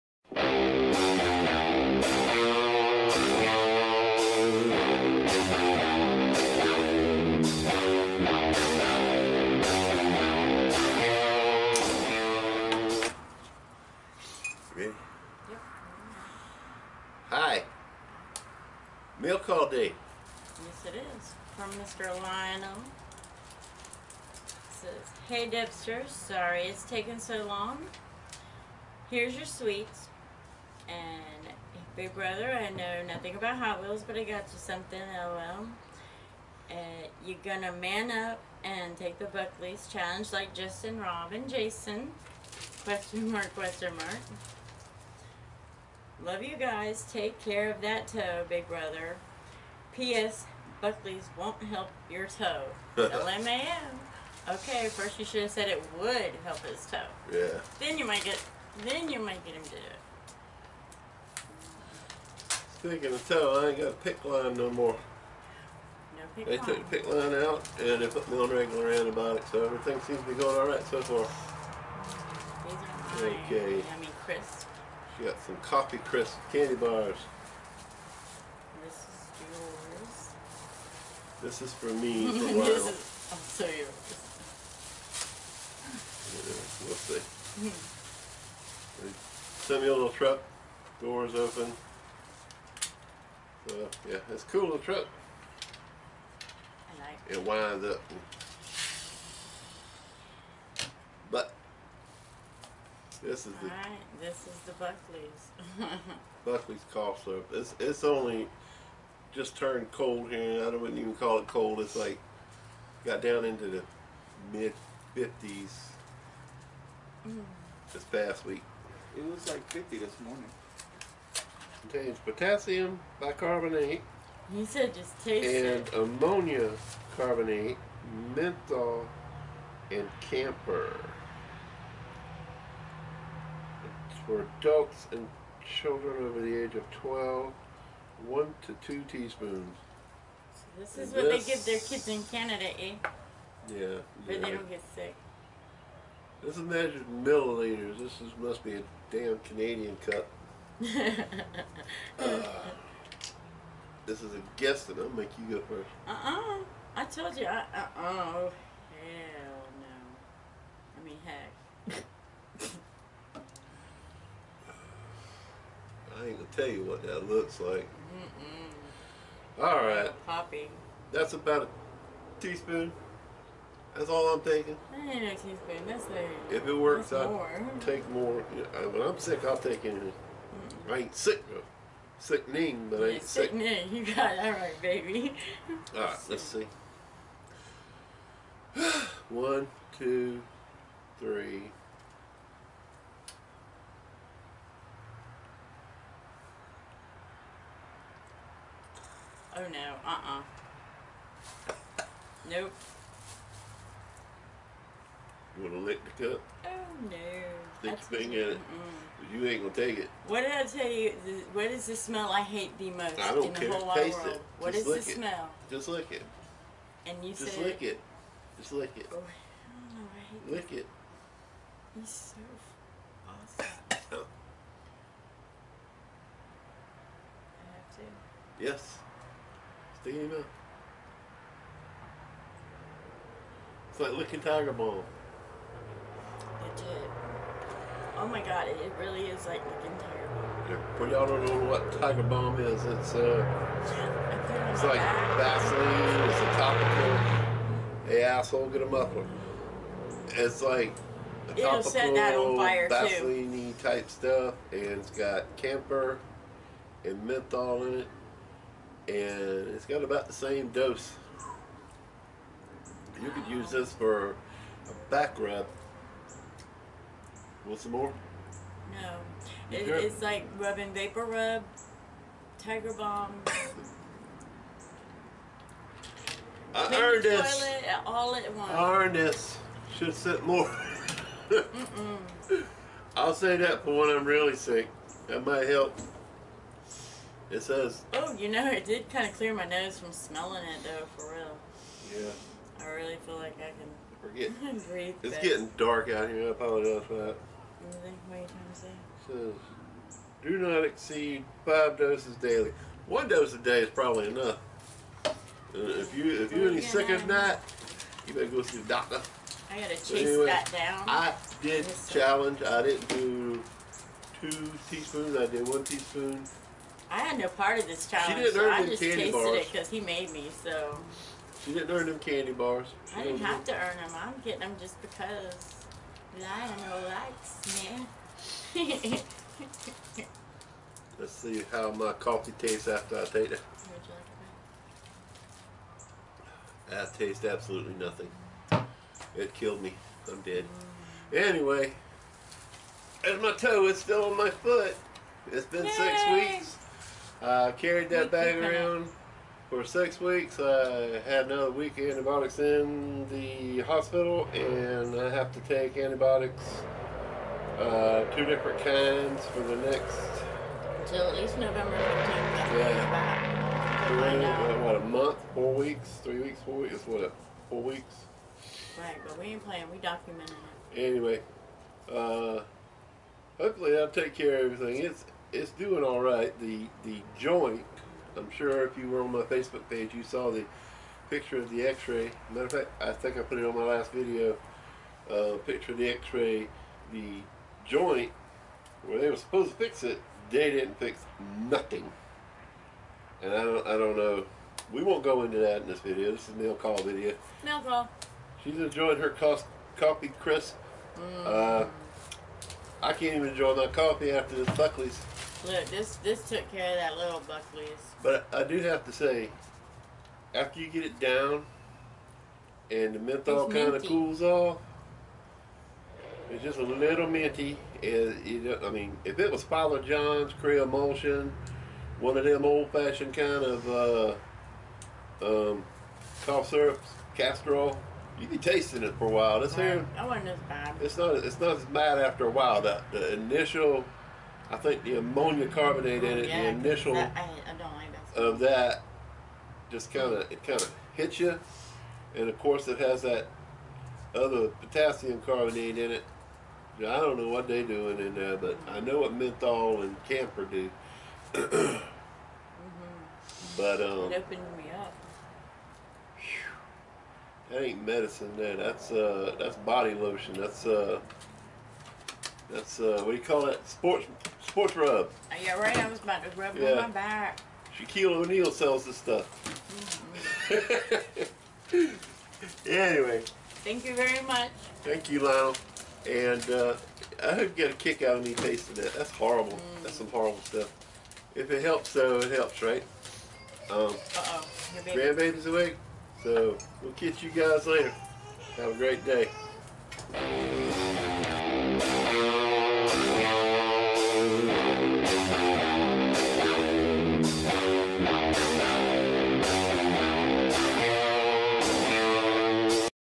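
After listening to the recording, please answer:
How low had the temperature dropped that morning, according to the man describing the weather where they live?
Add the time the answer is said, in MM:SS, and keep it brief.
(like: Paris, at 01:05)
50, at 01:59.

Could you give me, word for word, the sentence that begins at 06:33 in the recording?
And I don't I don't know.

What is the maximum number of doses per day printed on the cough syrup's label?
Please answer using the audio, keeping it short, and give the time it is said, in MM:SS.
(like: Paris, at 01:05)
5, at 05:01.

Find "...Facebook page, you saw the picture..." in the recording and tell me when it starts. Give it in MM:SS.
06:19.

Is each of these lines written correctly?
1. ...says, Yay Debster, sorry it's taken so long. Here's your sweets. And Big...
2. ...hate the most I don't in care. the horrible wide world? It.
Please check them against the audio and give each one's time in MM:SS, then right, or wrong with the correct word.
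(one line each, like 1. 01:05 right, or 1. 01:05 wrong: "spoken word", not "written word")
1. 00:24 wrong: "Hey", not "Yay"
2. 03:32 wrong: "whole", not "horrible".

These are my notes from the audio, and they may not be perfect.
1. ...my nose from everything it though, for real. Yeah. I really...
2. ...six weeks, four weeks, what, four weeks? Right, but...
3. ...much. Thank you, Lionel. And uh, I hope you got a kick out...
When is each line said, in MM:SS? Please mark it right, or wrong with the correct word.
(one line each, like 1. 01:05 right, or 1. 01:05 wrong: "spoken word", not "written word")
1. 04:49 wrong: "smelling", not "everything"
2. 06:06 wrong: "three", not "six"
3. 07:54 right.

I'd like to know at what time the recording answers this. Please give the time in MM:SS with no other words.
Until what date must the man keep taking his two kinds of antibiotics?
06:01.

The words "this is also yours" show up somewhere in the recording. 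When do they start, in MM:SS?
01:22.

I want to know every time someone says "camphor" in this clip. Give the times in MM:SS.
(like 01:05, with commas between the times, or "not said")
02:10, 04:15, 07:30.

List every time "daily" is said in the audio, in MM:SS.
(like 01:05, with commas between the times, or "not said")
05:02.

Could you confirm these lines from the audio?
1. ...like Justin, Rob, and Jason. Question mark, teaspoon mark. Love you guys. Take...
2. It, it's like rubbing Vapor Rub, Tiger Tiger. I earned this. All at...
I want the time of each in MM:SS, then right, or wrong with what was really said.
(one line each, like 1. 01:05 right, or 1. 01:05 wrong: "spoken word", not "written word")
1. 00:40 wrong: "question", not "teaspoon"
2. 04:29 wrong: "Balm", not "Tiger".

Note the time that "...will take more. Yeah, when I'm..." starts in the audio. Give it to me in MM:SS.
02:57.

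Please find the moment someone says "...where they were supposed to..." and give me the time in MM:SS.
06:29.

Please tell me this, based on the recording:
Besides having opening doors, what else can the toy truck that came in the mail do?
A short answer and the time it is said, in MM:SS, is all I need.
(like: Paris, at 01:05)
It winds up, at 01:37.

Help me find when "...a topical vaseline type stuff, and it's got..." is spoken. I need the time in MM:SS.
04:11.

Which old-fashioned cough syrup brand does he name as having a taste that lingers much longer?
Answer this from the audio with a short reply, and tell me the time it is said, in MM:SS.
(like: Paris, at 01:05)
Father John's, at 06:59.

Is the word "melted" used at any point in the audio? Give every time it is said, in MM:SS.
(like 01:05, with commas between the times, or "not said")
not said.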